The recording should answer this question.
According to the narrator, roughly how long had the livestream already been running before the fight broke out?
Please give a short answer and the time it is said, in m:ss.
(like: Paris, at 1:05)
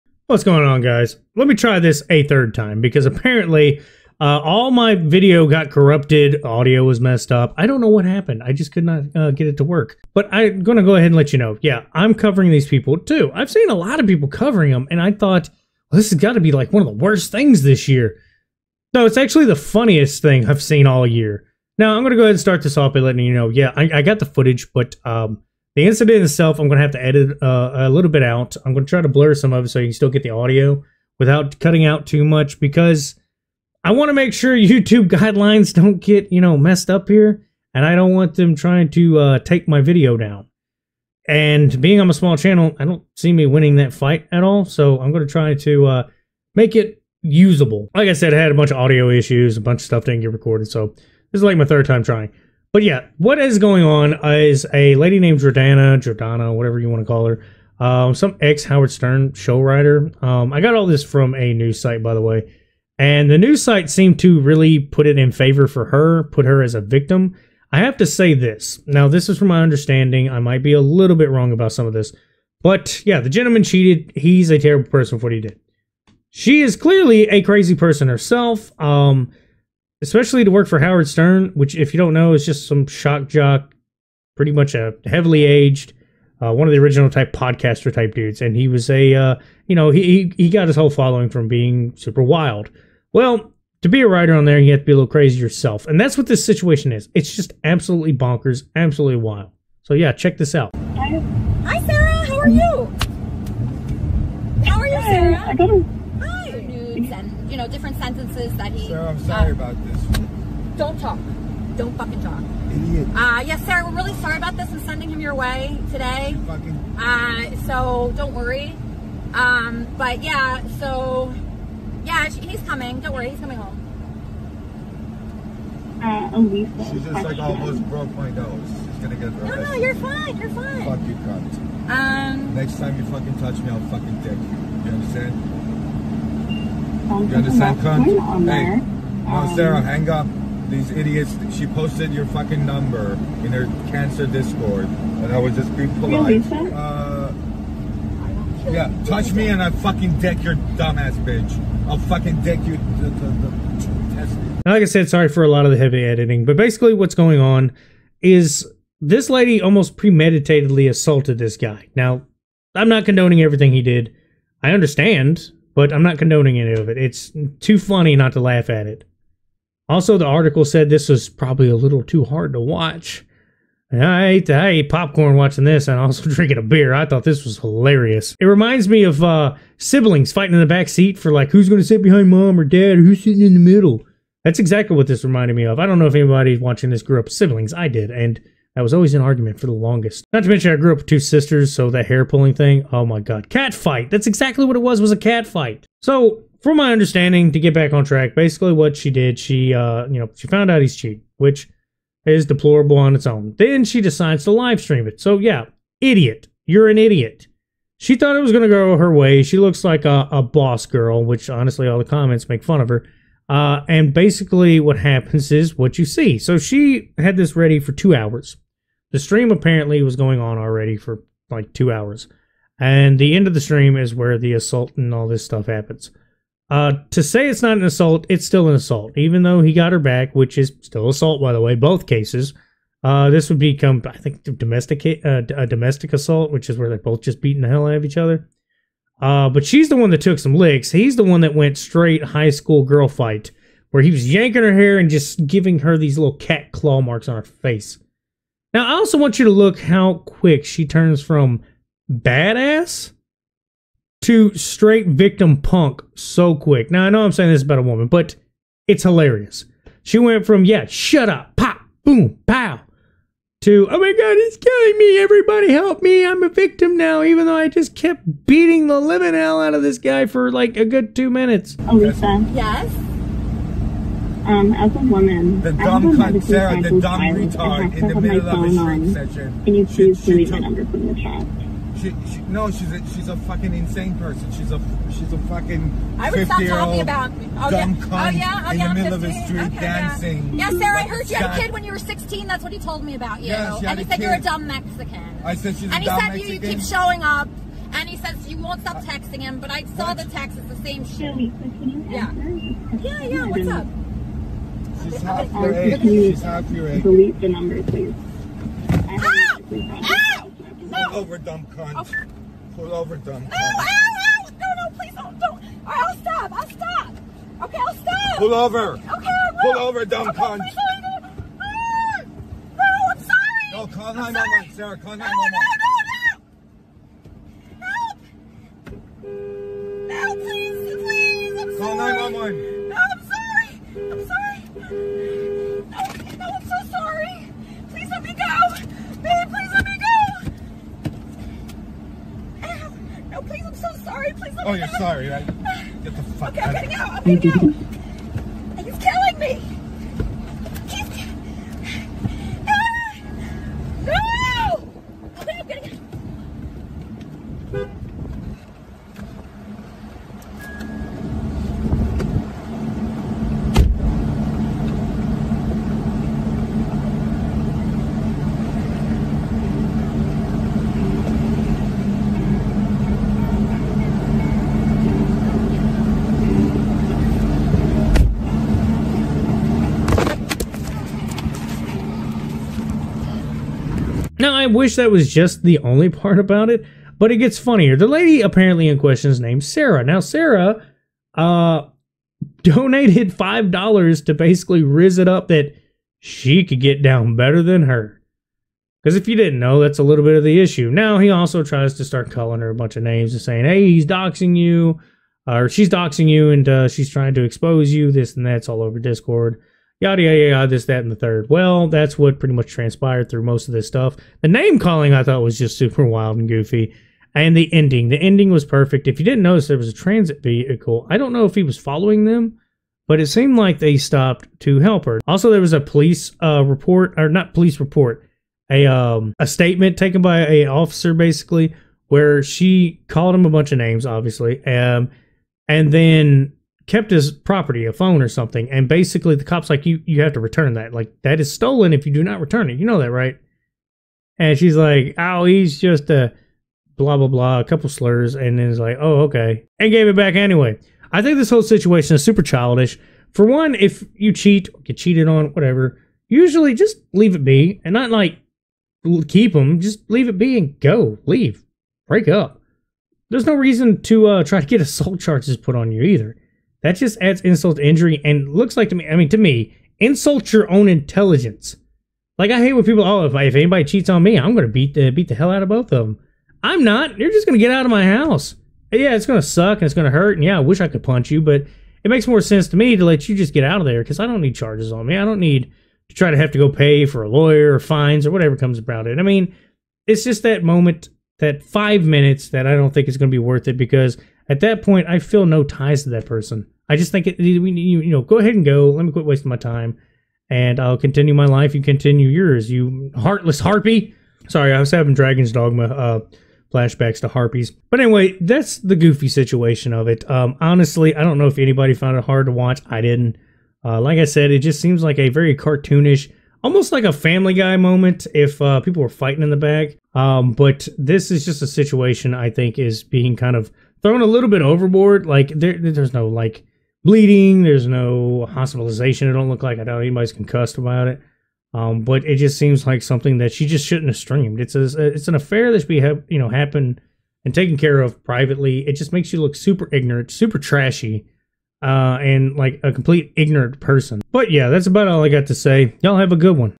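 2 hours, at 3:41.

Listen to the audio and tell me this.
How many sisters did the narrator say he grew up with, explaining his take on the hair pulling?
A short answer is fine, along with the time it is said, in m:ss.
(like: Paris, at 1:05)
2, at 3:11.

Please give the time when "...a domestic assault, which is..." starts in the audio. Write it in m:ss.
3:55.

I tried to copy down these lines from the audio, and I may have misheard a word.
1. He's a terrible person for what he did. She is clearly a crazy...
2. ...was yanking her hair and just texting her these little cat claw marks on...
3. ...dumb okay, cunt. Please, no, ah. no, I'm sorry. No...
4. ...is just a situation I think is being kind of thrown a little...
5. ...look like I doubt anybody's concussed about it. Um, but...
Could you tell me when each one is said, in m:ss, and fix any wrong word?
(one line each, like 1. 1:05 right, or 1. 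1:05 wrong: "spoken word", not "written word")
1. 1:14 right
2. 4:04 wrong: "giving", not "texting"
3. 5:20 right
4. 8:41 right
5. 8:49 right.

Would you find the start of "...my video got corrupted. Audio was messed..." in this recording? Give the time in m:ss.
0:04.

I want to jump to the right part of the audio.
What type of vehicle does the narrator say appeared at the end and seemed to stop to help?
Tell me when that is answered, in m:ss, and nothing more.
6:59.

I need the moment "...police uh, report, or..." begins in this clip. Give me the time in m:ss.
7:05.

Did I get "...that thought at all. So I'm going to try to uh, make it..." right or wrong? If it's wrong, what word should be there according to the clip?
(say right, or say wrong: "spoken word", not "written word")
wrong: "fight", not "thought".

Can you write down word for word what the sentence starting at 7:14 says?
Um and then kept his property, a phone or something, and basically the cops like you you have to return that.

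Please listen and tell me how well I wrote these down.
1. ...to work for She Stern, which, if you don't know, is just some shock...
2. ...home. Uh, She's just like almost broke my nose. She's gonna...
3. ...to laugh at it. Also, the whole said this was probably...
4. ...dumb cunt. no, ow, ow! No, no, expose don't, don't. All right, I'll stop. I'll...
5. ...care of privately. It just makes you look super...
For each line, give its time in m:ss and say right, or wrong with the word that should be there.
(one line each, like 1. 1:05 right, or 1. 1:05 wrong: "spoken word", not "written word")
1. 1:20 wrong: "Howard", not "She"
2. 2:03 right
3. 2:48 wrong: "article", not "whole"
4. 5:13 wrong: "please", not "expose"
5. 8:57 right.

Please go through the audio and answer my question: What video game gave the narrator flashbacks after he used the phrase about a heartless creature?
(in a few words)
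Dragon's Dogma.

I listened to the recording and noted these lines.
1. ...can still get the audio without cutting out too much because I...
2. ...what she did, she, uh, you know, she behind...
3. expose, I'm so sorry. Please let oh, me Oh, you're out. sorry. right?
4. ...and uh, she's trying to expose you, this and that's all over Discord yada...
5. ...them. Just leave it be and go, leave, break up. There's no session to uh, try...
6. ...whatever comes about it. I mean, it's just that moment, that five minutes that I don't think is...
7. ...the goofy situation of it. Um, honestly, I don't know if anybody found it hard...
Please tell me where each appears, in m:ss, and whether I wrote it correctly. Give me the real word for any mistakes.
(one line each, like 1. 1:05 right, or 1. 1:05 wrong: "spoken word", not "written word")
1. 0:29 right
2. 3:18 wrong: "found", not "behind"
3. 5:43 wrong: "please", not "expose"
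4. 6:46 right
5. 7:39 wrong: "reason", not "session"
6. 8:08 right
7. 8:28 right.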